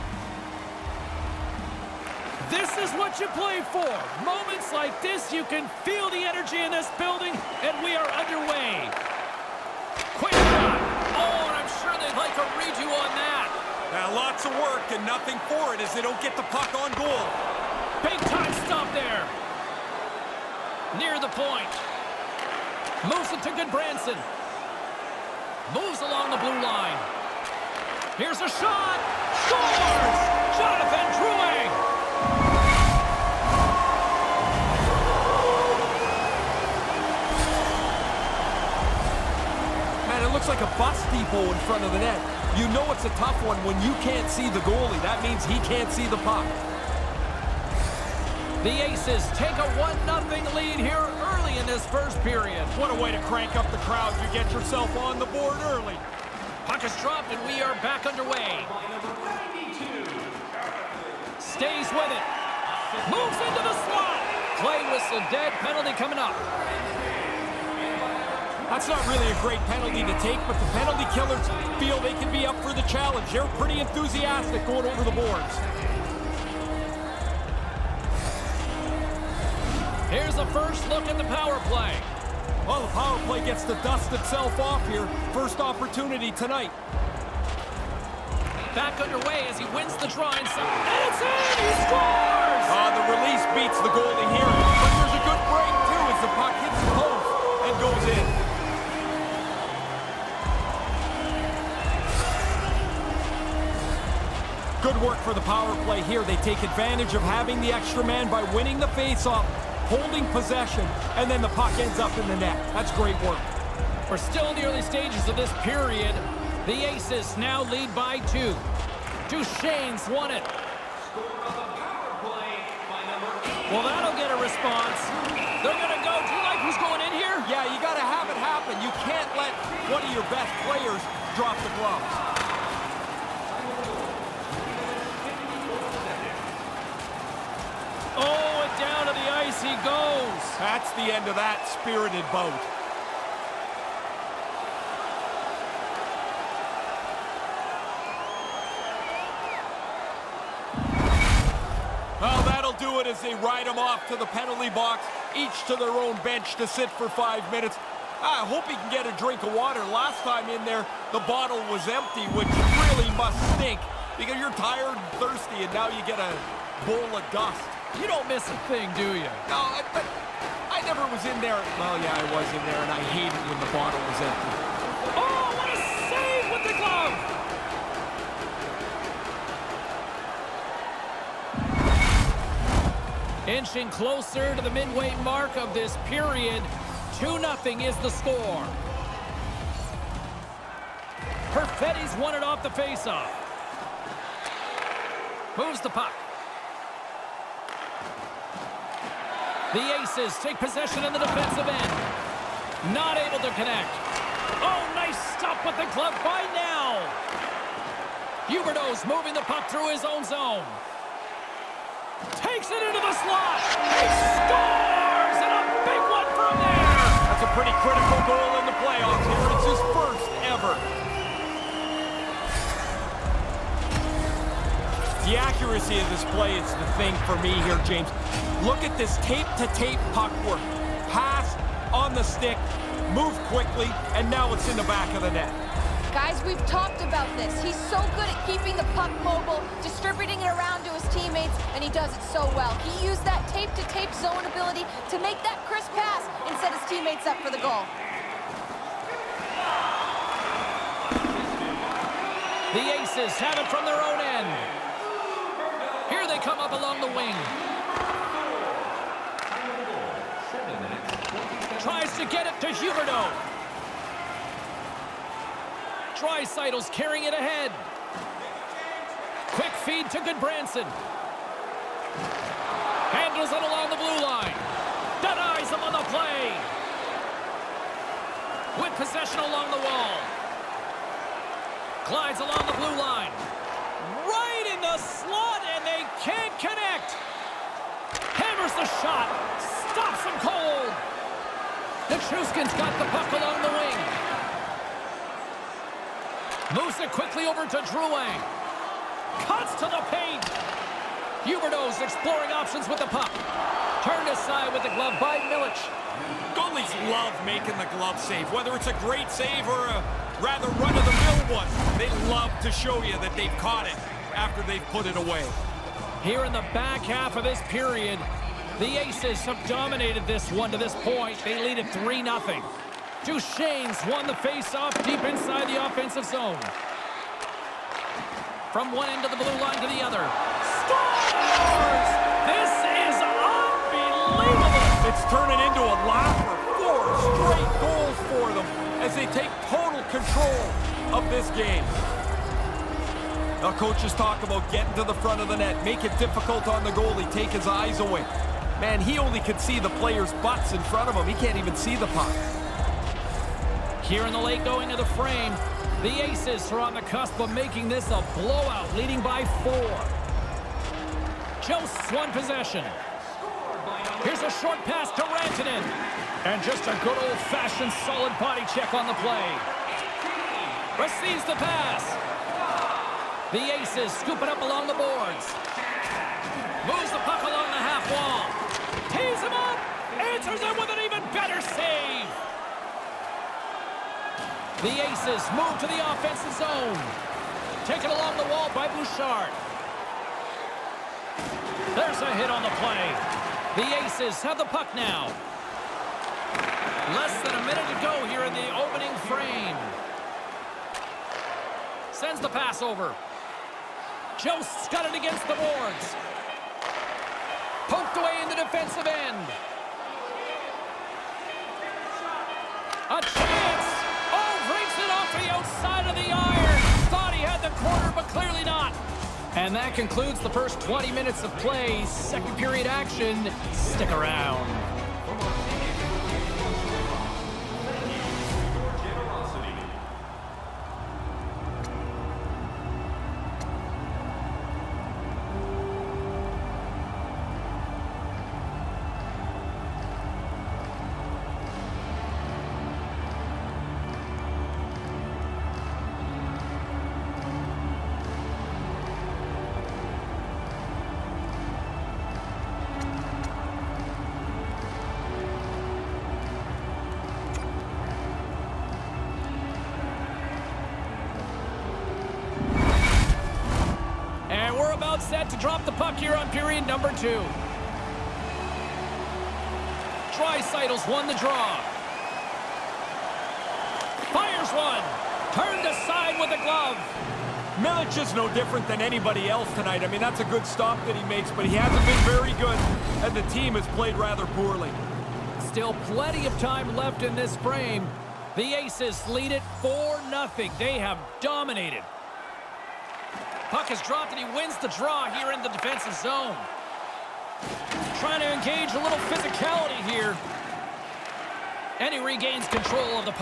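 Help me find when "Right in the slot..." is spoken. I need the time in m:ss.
4:44.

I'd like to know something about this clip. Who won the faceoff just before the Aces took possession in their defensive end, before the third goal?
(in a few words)
Perfetti.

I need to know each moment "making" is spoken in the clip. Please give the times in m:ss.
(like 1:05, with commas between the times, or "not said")
5:07, 5:57.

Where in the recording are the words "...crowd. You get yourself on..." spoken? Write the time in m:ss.
0:53.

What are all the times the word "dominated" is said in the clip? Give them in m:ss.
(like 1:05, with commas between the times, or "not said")
5:19, 8:11.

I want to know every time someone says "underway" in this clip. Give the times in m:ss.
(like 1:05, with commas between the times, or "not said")
0:08, 0:58, 1:29.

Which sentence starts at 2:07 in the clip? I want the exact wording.
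Yeah, you got to have it happen.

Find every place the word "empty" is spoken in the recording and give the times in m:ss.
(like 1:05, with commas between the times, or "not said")
2:41, 2:54.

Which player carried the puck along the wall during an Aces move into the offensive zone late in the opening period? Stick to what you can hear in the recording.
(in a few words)
Bouchard.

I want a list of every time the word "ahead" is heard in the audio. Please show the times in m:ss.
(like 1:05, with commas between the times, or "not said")
4:27.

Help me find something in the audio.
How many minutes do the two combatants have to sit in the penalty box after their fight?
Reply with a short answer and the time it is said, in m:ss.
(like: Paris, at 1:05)
5, at 2:37.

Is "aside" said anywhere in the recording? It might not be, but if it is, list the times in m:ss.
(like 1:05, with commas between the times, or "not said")
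5:04, 7:55.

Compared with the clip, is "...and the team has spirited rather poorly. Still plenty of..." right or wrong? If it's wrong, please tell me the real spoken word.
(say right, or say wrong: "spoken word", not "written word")
wrong: "played", not "spirited".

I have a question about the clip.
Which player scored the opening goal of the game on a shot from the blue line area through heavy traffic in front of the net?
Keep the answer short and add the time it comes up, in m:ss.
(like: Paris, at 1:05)
Jonathan Drouin, at 0:30.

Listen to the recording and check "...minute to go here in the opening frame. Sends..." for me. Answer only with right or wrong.
right.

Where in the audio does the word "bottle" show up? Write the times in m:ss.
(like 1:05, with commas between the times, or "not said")
2:41, 2:53.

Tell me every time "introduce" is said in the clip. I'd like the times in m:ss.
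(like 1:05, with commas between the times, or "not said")
not said.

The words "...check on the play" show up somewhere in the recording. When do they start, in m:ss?
6:08.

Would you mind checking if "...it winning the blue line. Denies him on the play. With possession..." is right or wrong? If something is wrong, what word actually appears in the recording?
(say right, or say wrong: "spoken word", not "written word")
wrong: "along", not "winning".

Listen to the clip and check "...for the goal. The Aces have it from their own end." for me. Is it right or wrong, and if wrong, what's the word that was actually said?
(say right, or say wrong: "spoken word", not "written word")
right.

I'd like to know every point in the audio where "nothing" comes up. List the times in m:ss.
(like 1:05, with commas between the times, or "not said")
0:15.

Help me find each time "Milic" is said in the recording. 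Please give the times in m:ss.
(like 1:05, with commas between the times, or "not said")
5:05, 7:57.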